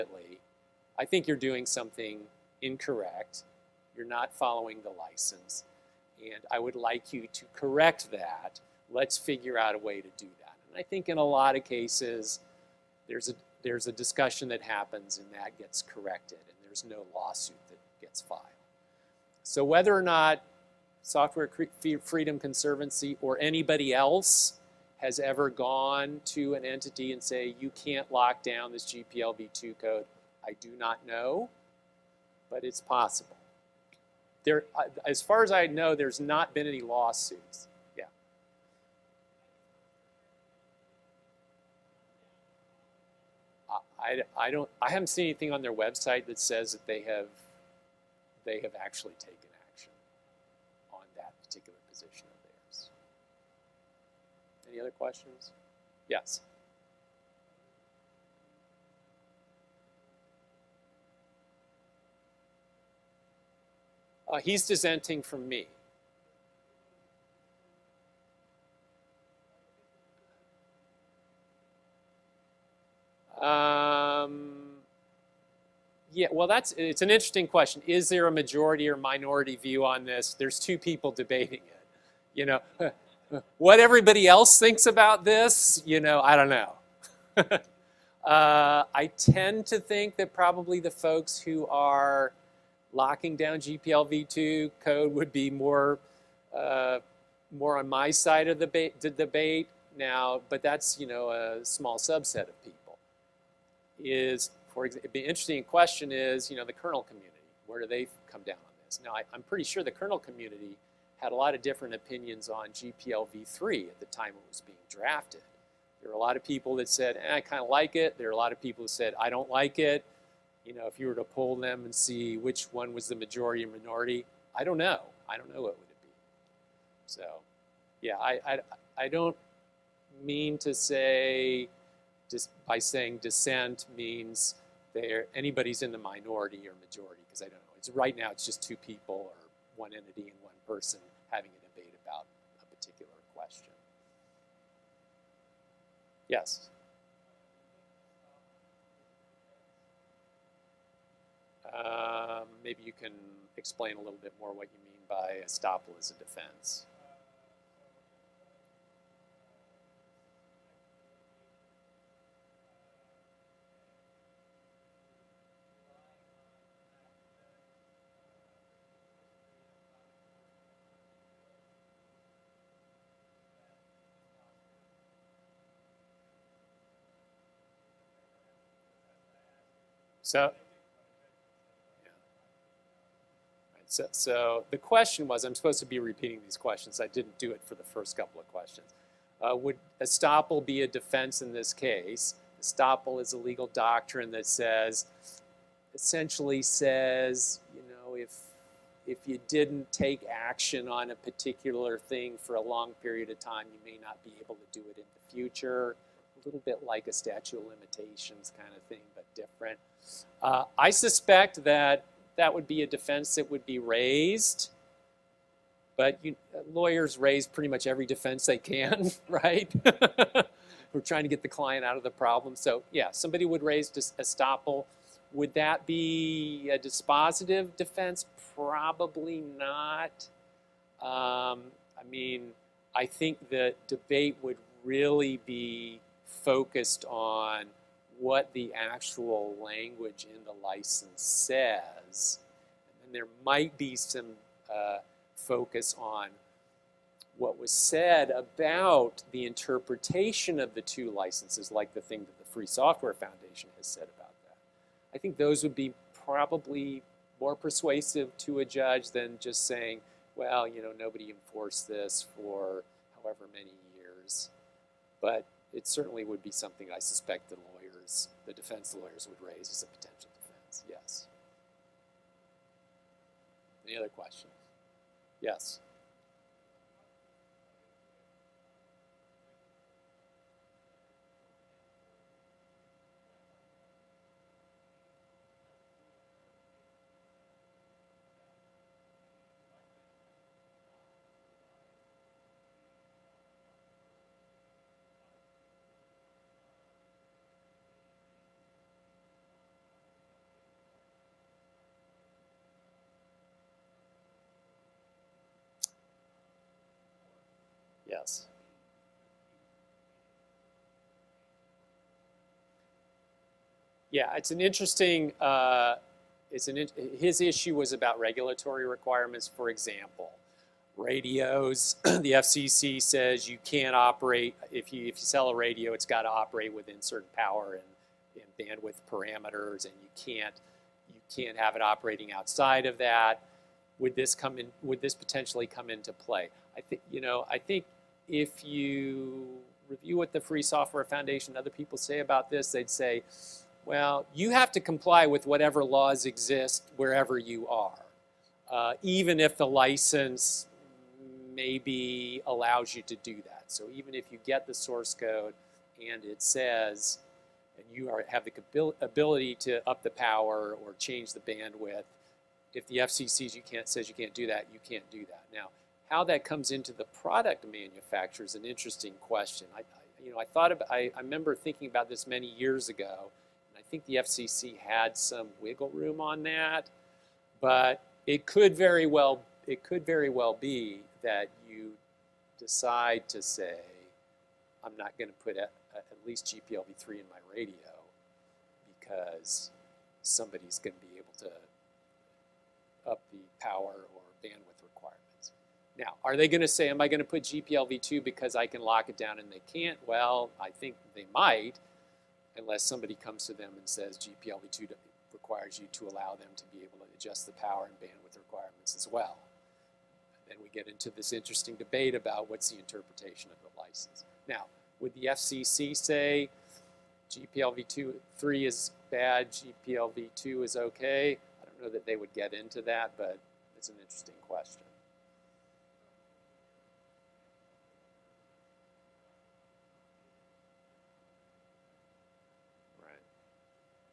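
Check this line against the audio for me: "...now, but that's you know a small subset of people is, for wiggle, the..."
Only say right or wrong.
wrong.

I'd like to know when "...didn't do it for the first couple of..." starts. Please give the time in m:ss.
3:07.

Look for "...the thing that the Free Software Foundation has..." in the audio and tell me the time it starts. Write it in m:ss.
4:11.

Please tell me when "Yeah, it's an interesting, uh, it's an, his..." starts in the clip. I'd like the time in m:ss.
5:14.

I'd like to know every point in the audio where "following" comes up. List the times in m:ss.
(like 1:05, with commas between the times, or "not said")
0:04.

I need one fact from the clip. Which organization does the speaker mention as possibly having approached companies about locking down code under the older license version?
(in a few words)
Software Freedom Conservancy.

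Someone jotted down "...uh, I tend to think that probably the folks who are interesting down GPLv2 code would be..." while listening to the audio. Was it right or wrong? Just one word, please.
wrong.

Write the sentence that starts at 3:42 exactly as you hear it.
So yeah, somebody would raise estoppel.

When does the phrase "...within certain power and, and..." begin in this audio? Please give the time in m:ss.
5:26.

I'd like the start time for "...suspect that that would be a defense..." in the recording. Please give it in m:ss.
3:30.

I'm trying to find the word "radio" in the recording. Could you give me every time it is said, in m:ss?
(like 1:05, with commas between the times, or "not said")
5:20, 5:25, 6:27.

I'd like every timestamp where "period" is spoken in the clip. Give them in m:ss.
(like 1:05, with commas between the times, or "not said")
3:23.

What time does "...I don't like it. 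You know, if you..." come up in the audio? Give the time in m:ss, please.
1:59.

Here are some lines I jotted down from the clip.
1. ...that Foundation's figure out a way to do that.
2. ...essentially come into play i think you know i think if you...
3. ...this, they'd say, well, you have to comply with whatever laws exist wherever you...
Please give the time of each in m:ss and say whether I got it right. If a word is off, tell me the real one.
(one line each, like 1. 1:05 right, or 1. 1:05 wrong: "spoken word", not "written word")
1. 0:08 wrong: "Let", not "Foundation"
2. 5:35 wrong: "potentially", not "essentially"
3. 5:42 right.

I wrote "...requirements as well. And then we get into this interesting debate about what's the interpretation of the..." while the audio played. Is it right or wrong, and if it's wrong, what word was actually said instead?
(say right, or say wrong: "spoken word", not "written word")
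right.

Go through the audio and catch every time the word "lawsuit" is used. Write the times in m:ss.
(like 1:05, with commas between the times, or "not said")
0:17, 0:36.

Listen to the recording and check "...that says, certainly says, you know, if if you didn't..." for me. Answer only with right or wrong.
wrong.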